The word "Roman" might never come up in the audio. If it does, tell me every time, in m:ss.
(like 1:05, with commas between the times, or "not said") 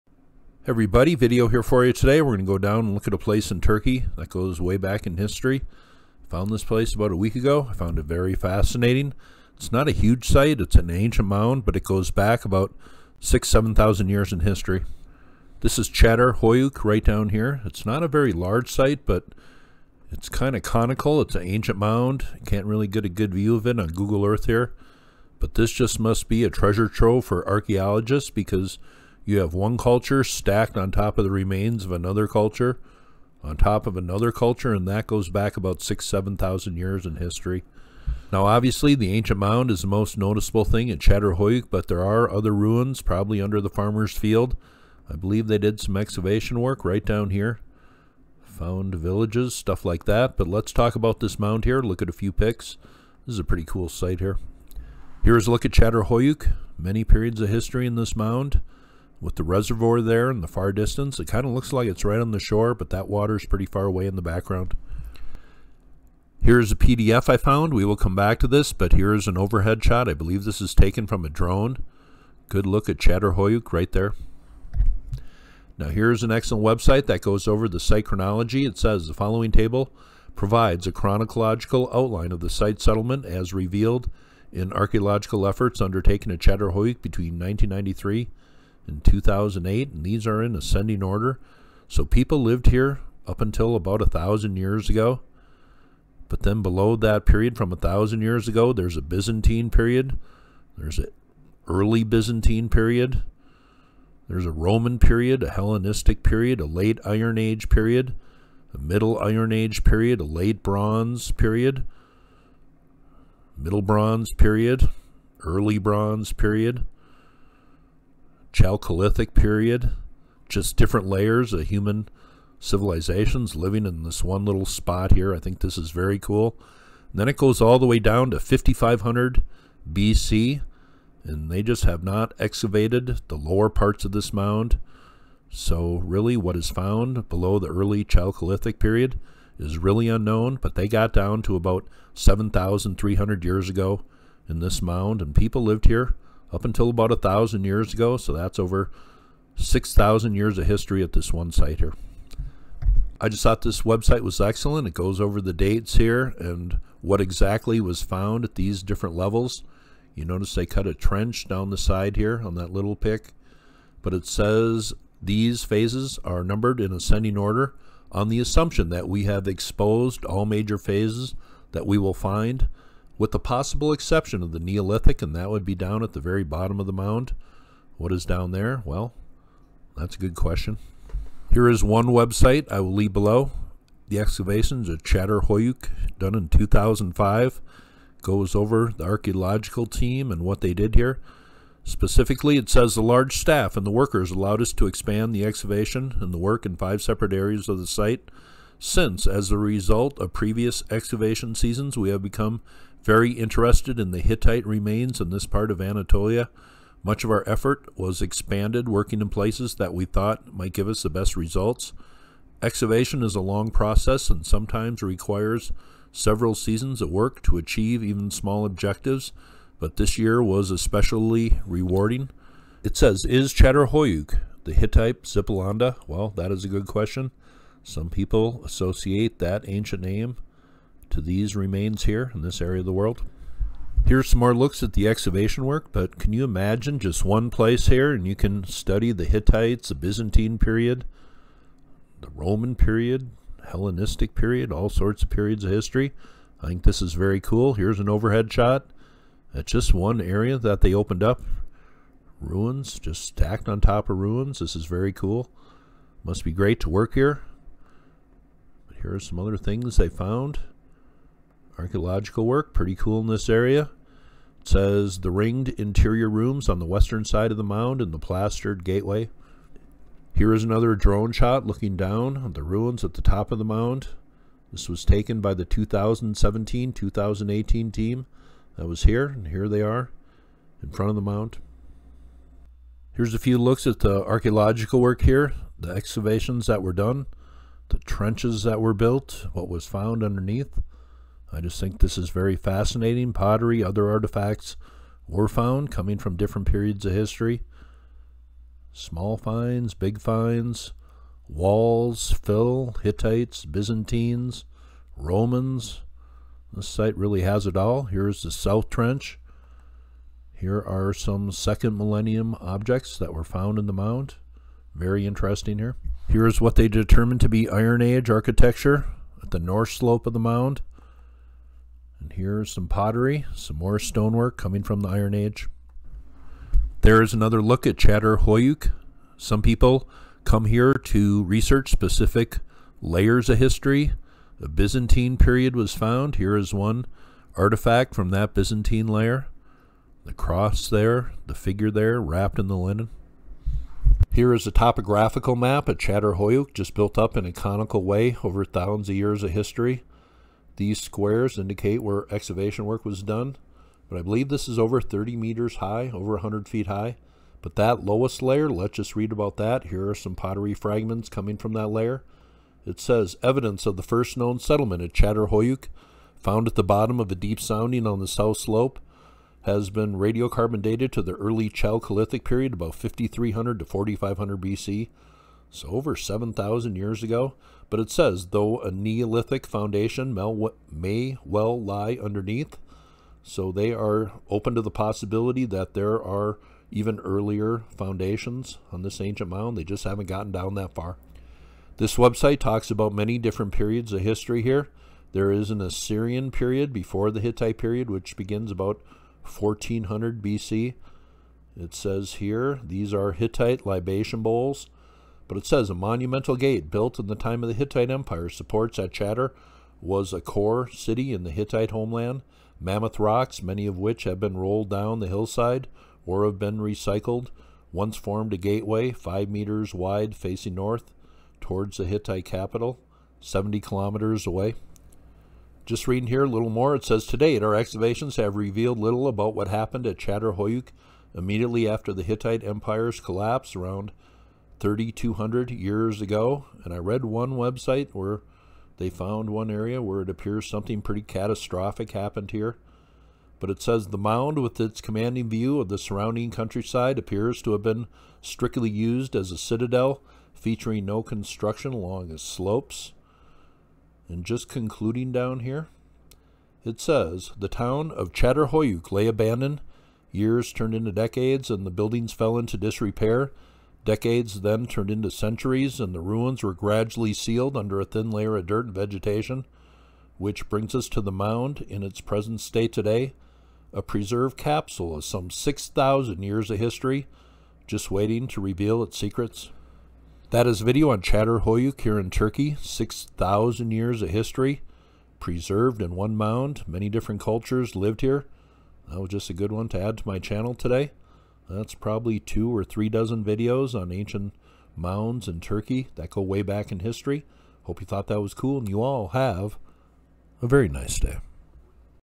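1:44, 4:02, 5:05.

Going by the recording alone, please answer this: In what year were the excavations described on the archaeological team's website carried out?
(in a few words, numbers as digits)
2005.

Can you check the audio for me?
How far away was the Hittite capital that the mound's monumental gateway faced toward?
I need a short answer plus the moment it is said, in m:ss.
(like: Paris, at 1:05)
70 kilometers, at 7:03.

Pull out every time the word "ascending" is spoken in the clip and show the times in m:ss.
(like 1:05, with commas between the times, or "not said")
1:30, 2:46.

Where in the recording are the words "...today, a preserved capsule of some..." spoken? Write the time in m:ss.
7:52.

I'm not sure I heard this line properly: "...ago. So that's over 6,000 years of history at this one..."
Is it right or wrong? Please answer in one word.
right.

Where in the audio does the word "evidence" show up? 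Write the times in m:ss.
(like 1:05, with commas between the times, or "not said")
6:03.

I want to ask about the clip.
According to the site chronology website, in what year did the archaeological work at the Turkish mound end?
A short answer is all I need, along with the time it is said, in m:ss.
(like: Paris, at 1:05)
2008, at 1:29.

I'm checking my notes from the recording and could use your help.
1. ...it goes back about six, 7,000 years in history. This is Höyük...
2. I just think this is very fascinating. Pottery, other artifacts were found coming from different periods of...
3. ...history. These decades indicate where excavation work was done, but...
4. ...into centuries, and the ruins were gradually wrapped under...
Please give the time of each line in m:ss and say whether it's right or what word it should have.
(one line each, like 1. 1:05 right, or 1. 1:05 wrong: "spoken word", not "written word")
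1. 0:11 wrong: "Çadır", not "Höyük"
2. 4:51 right
3. 5:49 wrong: "squares", not "decades"
4. 7:45 wrong: "sealed", not "wrapped".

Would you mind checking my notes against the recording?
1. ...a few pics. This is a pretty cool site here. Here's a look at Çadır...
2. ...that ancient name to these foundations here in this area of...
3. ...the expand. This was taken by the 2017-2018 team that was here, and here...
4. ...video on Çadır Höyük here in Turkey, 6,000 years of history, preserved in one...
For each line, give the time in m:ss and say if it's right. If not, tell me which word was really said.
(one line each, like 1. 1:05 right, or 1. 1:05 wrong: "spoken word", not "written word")
1. 0:52 right
2. 3:49 wrong: "remains", not "foundations"
3. 4:33 wrong: "mound", not "expand"
4. 8:00 right.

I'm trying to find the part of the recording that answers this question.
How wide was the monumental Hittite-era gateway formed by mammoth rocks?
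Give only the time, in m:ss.
6:59.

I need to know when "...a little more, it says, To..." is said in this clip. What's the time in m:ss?
7:06.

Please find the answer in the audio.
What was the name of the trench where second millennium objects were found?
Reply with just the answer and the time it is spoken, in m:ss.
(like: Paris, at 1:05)
South Trench, at 5:08.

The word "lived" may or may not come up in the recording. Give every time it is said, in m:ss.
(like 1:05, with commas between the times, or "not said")
1:32, 2:25, 8:07.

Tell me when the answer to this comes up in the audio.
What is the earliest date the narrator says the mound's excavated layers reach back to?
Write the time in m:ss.
2:08.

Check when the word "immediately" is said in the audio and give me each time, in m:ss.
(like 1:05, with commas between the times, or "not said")
7:11.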